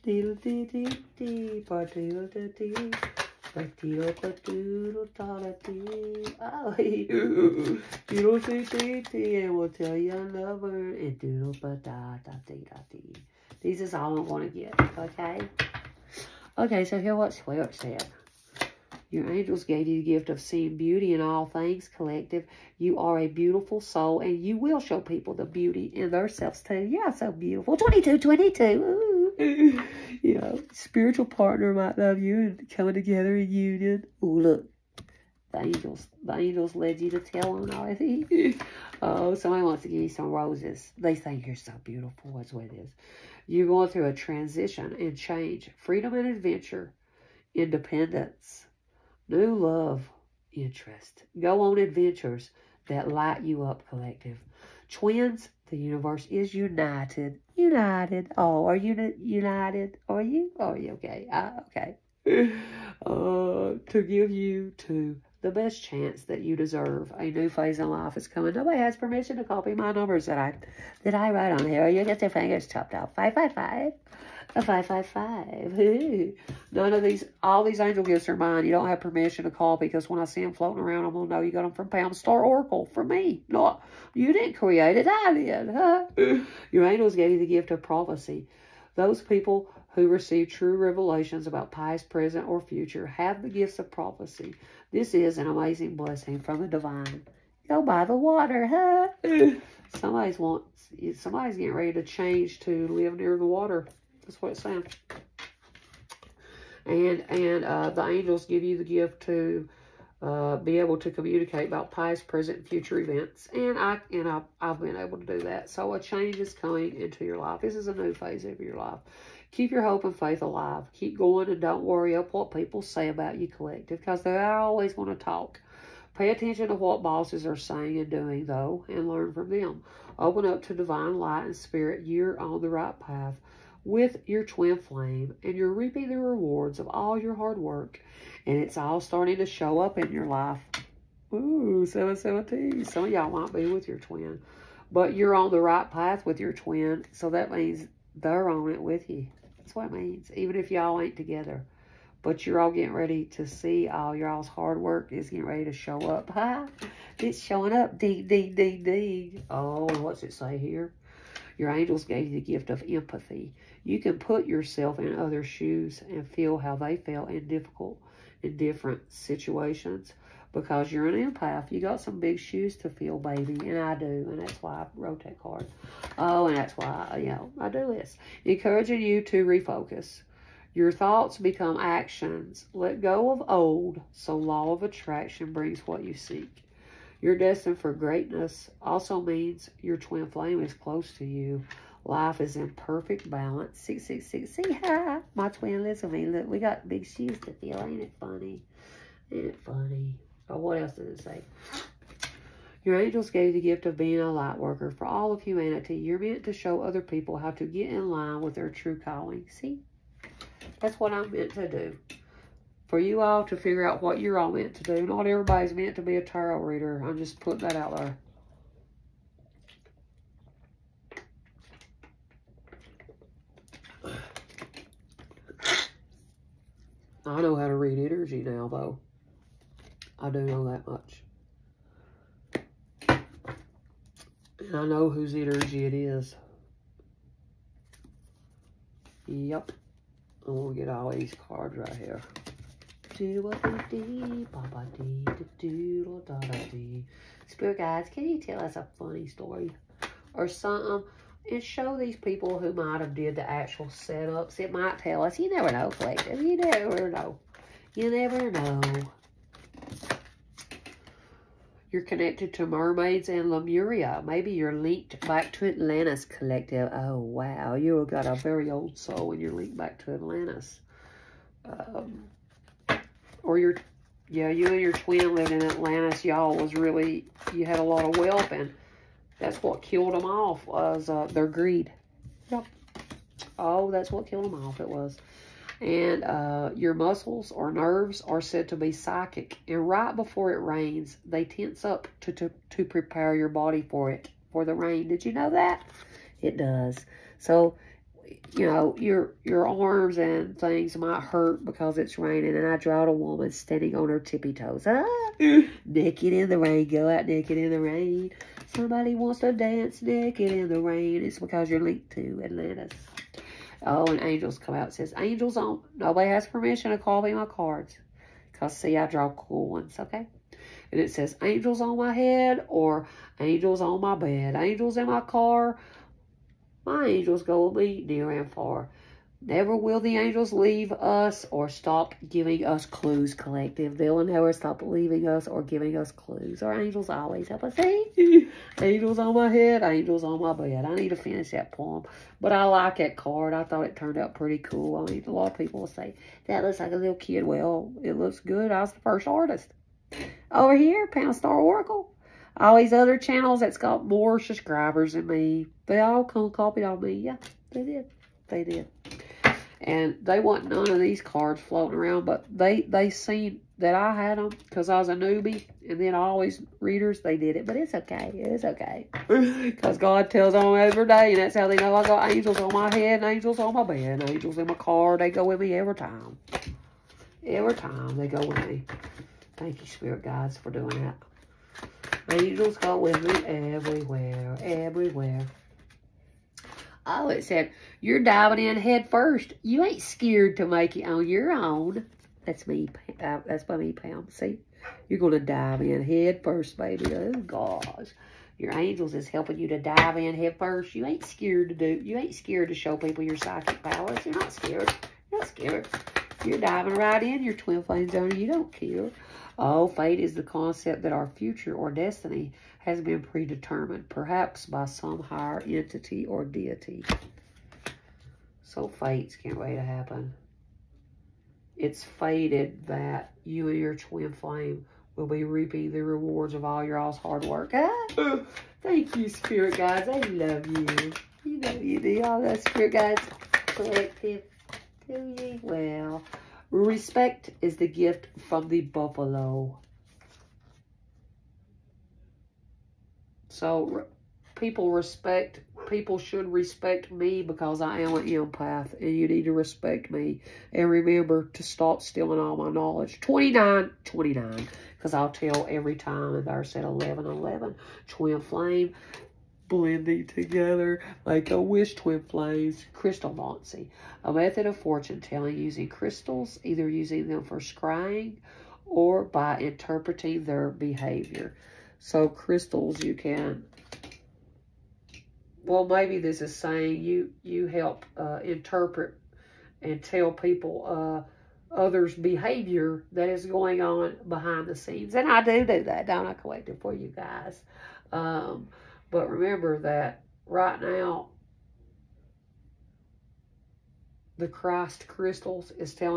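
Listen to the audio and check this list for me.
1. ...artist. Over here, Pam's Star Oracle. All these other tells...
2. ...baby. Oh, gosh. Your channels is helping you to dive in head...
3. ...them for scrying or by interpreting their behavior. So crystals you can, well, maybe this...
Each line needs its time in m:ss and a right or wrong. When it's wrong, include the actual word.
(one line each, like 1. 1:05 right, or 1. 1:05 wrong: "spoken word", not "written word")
1. 5:49 wrong: "channels", not "tells"
2. 6:36 wrong: "angels", not "channels"
3. 7:47 right.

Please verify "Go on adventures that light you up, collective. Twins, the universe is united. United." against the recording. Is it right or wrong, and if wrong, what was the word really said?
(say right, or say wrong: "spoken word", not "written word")
right.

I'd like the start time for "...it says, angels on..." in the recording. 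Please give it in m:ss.
5:21.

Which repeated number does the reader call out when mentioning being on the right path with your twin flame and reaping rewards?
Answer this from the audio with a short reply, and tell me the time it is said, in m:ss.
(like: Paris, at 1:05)
717, at 2:21.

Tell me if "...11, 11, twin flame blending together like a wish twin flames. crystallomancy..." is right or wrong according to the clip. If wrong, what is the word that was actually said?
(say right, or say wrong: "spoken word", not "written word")
right.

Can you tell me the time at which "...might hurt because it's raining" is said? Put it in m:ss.
5:00.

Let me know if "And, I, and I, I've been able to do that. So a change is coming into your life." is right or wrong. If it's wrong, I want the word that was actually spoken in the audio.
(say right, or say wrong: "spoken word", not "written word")
right.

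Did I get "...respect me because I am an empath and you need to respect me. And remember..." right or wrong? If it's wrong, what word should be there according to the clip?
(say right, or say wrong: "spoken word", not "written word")
right.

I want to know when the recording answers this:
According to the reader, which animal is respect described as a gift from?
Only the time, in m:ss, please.
7:18.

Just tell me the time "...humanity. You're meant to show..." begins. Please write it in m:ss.
3:25.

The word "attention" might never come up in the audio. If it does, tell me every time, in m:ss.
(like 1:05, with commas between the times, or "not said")
2:06.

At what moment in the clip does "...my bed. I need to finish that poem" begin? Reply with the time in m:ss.
5:40.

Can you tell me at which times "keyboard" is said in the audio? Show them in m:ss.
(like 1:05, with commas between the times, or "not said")
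not said.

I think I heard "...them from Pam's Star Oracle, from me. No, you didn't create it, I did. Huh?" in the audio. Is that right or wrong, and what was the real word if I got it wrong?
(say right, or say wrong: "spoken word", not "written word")
right.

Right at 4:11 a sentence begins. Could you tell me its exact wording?
And show these people who might have did the actual setups.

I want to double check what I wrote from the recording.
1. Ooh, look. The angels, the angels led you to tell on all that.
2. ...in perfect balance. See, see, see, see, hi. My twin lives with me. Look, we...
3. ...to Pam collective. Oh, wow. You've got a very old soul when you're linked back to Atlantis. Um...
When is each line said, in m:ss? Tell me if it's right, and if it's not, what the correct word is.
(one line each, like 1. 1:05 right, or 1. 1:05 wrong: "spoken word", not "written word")
1. 0:34 right
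2. 3:12 right
3. 4:25 wrong: "Atlantis", not "Pam".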